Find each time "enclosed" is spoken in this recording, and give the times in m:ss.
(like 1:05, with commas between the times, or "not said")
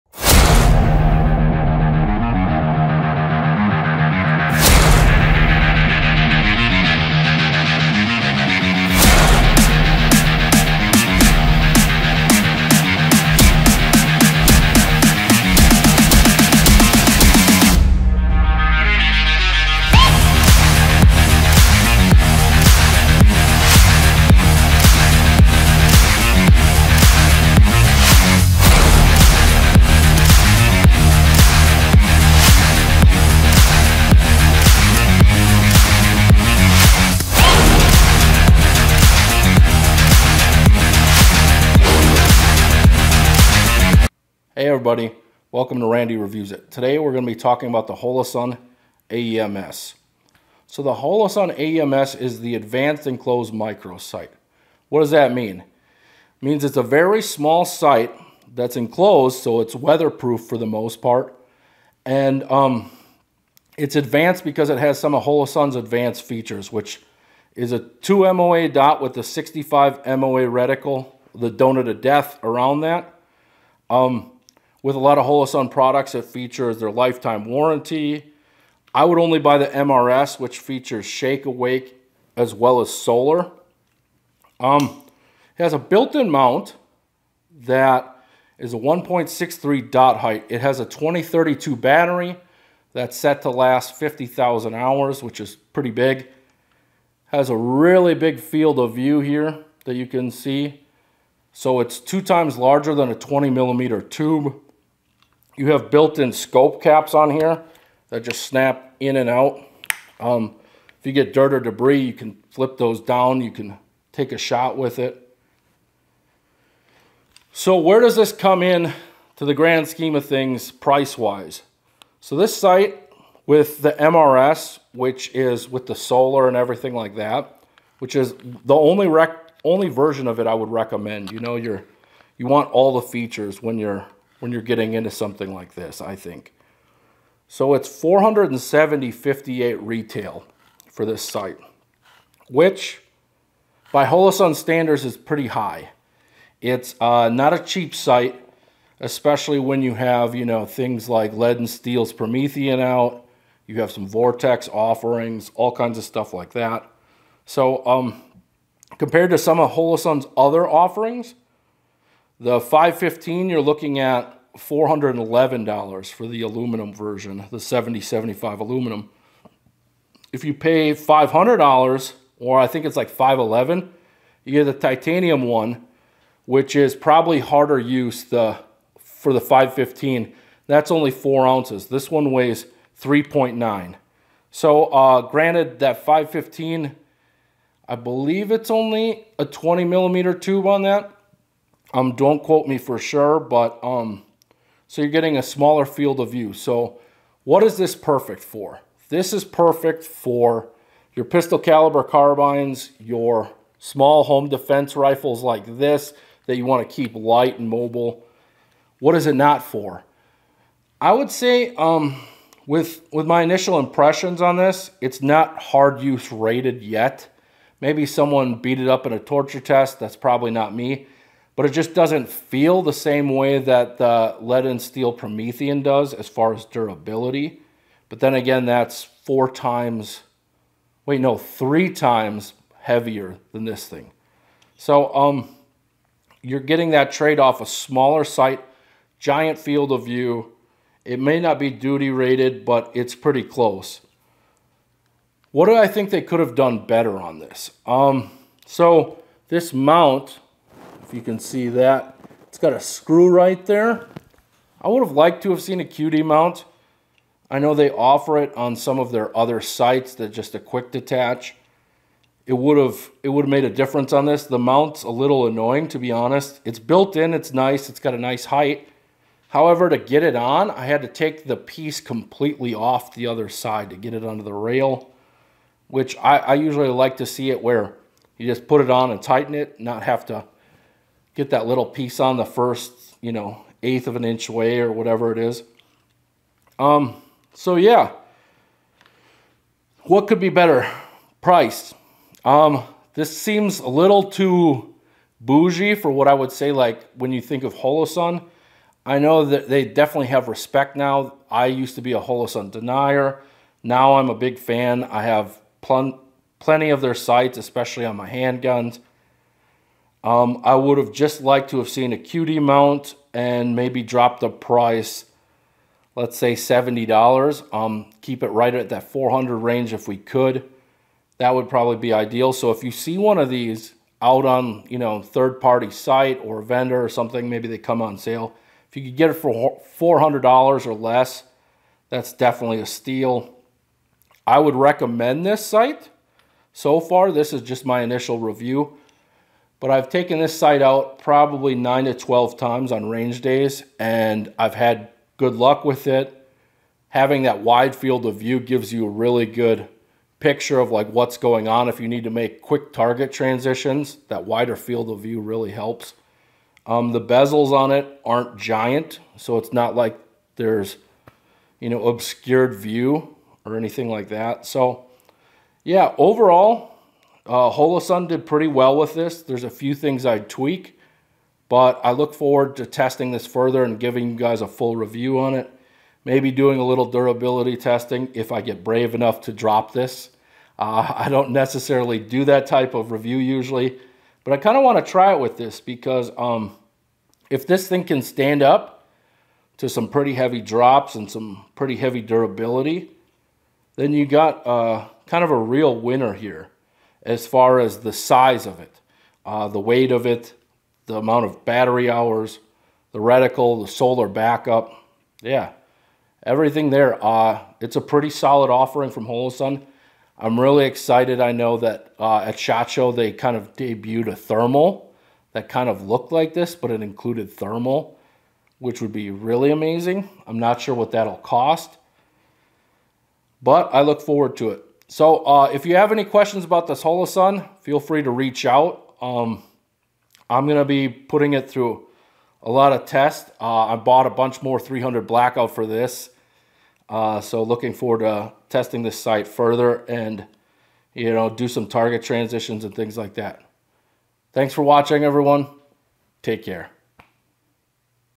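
0:53, 0:58.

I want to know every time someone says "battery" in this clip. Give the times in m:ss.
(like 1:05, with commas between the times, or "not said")
1:31, 6:41.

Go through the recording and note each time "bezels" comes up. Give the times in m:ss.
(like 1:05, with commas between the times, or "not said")
5:57.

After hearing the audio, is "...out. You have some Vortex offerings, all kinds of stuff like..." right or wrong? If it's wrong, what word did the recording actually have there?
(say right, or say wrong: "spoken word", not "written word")
right.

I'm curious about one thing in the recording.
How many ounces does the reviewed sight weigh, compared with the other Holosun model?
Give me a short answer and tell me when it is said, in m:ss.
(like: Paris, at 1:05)
3.9 ounces, at 3:02.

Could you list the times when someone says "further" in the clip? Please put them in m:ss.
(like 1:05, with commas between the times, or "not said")
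6:13, 7:19.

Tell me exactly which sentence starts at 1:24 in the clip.
Um, it has a built-in mount that is a 1.63 dot height.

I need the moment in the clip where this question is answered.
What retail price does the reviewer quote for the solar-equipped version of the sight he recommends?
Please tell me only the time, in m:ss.
2:17.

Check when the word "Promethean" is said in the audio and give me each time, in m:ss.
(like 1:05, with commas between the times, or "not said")
2:32, 3:45.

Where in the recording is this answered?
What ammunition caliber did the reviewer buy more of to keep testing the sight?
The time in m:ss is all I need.
7:14.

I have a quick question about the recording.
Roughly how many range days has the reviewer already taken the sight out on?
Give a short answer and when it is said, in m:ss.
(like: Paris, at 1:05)
9 to 12, at 5:41.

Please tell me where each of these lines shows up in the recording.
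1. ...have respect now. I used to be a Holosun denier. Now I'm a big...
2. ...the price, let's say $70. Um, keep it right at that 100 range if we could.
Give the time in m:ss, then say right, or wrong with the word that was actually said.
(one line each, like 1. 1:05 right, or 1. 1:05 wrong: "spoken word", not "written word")
1. 5:00 right
2. 5:14 wrong: "400", not "100".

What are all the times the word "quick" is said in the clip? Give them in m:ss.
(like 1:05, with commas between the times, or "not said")
4:20, 5:52.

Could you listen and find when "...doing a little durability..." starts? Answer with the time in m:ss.
6:16.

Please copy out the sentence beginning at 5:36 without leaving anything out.
So far, this is just my initial review.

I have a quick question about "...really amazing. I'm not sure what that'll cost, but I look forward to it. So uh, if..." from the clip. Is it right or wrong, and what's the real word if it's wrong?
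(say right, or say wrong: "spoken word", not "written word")
right.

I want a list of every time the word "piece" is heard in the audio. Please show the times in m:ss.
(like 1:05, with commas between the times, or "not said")
4:31, 4:41.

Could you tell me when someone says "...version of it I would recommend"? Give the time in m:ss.
2:09.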